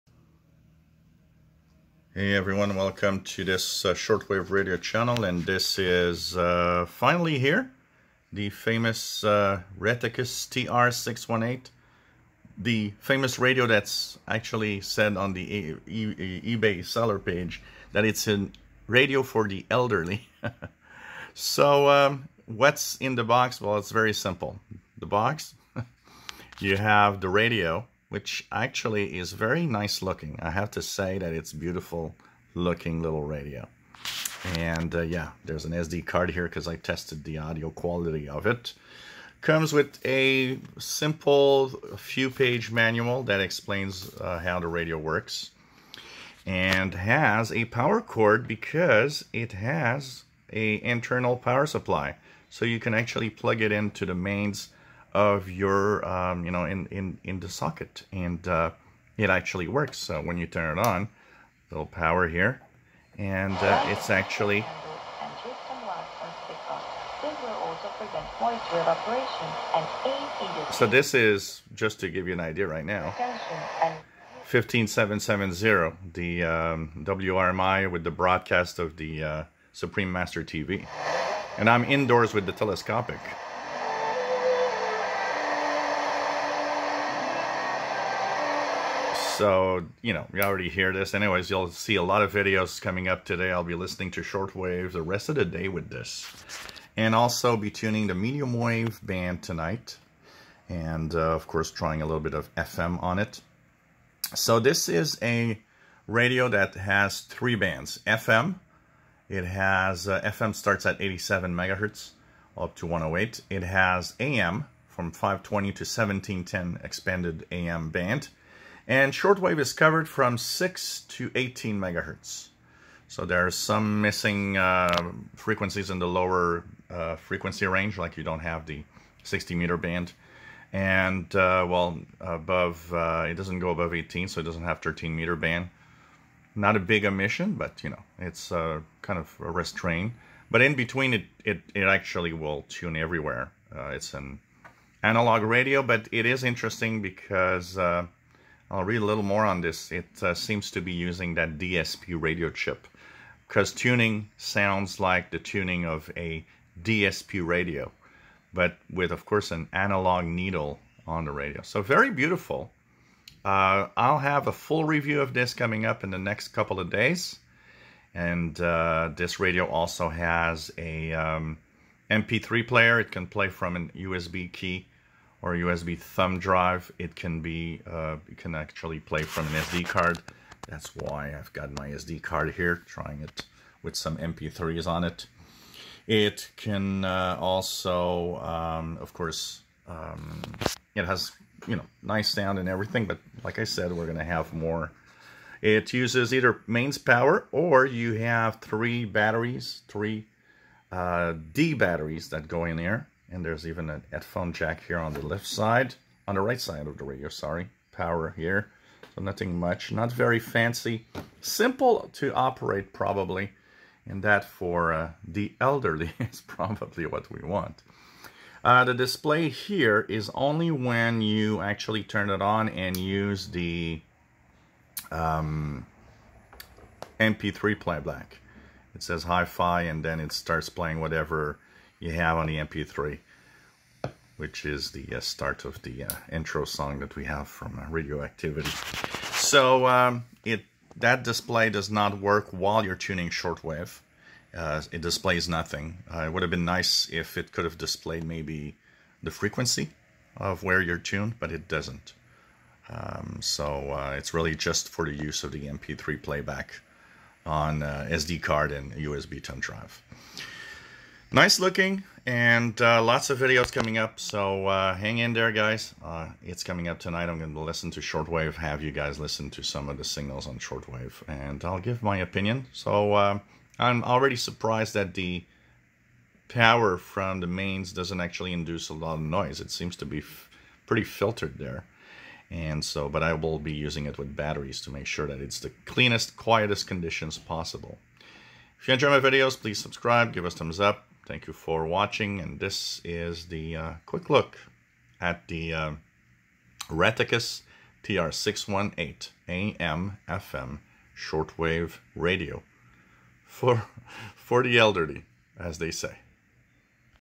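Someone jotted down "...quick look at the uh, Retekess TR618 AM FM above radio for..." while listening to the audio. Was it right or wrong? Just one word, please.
wrong.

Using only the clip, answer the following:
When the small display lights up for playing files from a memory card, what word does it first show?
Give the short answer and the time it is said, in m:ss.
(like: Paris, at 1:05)
hi-fi, at 3:49.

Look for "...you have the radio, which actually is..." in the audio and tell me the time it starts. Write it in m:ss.
0:26.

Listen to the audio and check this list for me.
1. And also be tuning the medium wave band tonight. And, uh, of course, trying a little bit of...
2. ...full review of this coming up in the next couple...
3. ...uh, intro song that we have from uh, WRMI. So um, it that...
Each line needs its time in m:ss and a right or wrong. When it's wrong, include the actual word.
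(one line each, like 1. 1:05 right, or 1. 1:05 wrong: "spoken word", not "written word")
1. 1:36 right
2. 2:44 right
3. 3:56 wrong: "Radioactivity", not "WRMI".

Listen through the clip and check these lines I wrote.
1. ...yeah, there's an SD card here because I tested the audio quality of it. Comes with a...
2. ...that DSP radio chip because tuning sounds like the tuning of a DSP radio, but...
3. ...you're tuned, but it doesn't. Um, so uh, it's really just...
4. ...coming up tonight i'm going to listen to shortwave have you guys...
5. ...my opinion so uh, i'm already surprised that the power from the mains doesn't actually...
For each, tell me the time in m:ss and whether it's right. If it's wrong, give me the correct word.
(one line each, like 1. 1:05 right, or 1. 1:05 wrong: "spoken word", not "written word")
1. 0:35 right
2. 2:31 right
3. 4:10 right
4. 4:26 right
5. 4:32 right.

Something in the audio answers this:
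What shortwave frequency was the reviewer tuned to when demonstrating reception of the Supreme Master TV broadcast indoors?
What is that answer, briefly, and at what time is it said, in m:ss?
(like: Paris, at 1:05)
15770, at 1:14.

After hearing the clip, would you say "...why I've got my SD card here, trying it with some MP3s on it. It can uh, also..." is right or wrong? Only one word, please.
right.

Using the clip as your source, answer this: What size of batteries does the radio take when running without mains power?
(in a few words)
D batteries.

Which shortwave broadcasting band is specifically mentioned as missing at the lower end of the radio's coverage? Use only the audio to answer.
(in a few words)
60 meter band.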